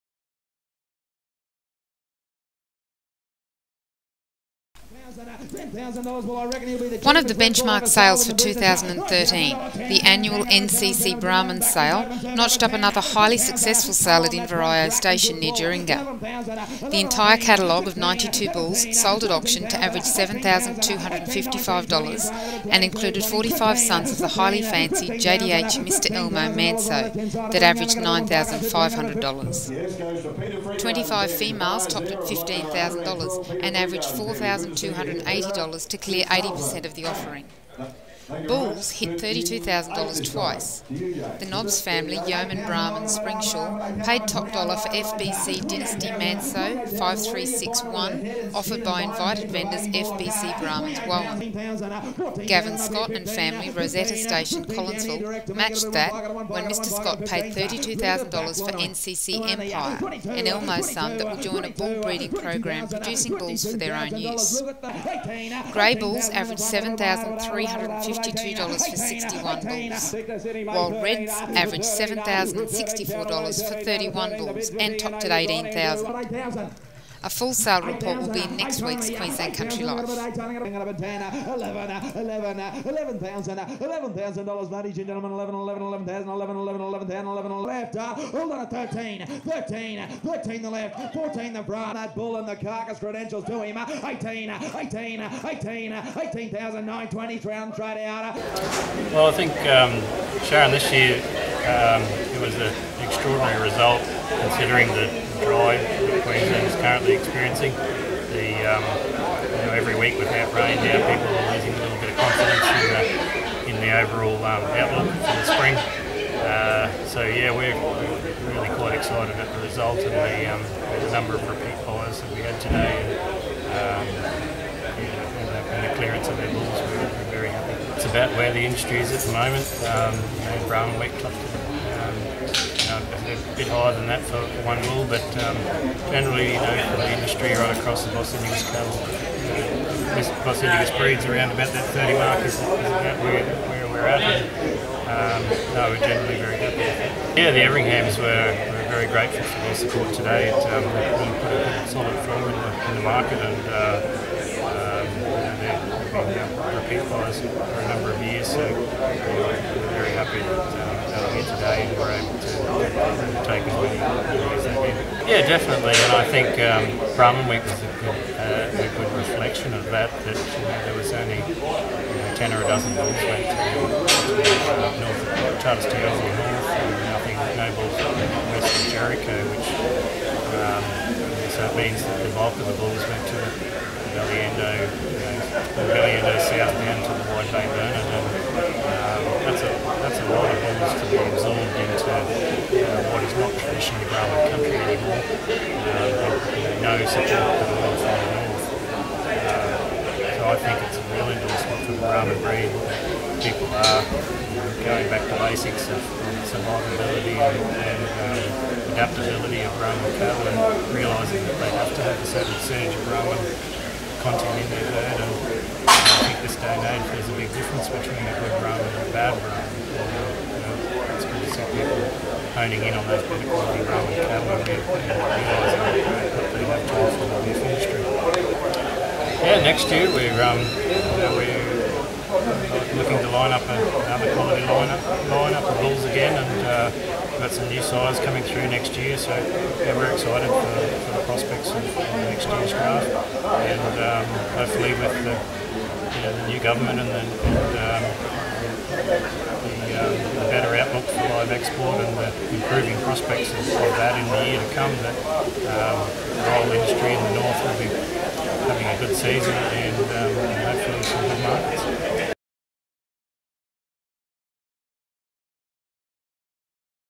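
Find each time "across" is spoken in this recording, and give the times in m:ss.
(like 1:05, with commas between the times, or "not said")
2:17.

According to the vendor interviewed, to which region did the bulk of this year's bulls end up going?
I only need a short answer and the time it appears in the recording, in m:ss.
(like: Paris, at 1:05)
Wide Bay Burnett, at 3:07.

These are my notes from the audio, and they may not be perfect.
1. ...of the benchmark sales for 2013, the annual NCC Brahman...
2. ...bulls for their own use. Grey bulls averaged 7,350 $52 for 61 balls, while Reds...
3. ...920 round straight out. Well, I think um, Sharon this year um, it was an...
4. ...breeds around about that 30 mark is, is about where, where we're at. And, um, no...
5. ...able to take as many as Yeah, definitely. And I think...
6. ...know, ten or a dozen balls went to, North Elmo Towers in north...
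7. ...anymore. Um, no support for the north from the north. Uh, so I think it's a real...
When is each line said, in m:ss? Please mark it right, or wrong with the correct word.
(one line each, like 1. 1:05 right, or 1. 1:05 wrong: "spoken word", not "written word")
1. 0:07 right
2. 1:03 right
3. 1:36 right
4. 2:20 right
5. 2:42 right
6. 2:51 wrong: "Charters", not "Elmo"
7. 3:14 right.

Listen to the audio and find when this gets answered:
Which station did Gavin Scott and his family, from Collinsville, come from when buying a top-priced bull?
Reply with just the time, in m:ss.
0:53.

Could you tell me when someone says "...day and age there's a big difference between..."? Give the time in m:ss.
3:36.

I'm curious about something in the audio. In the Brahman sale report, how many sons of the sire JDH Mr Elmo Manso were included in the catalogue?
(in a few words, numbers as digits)
45.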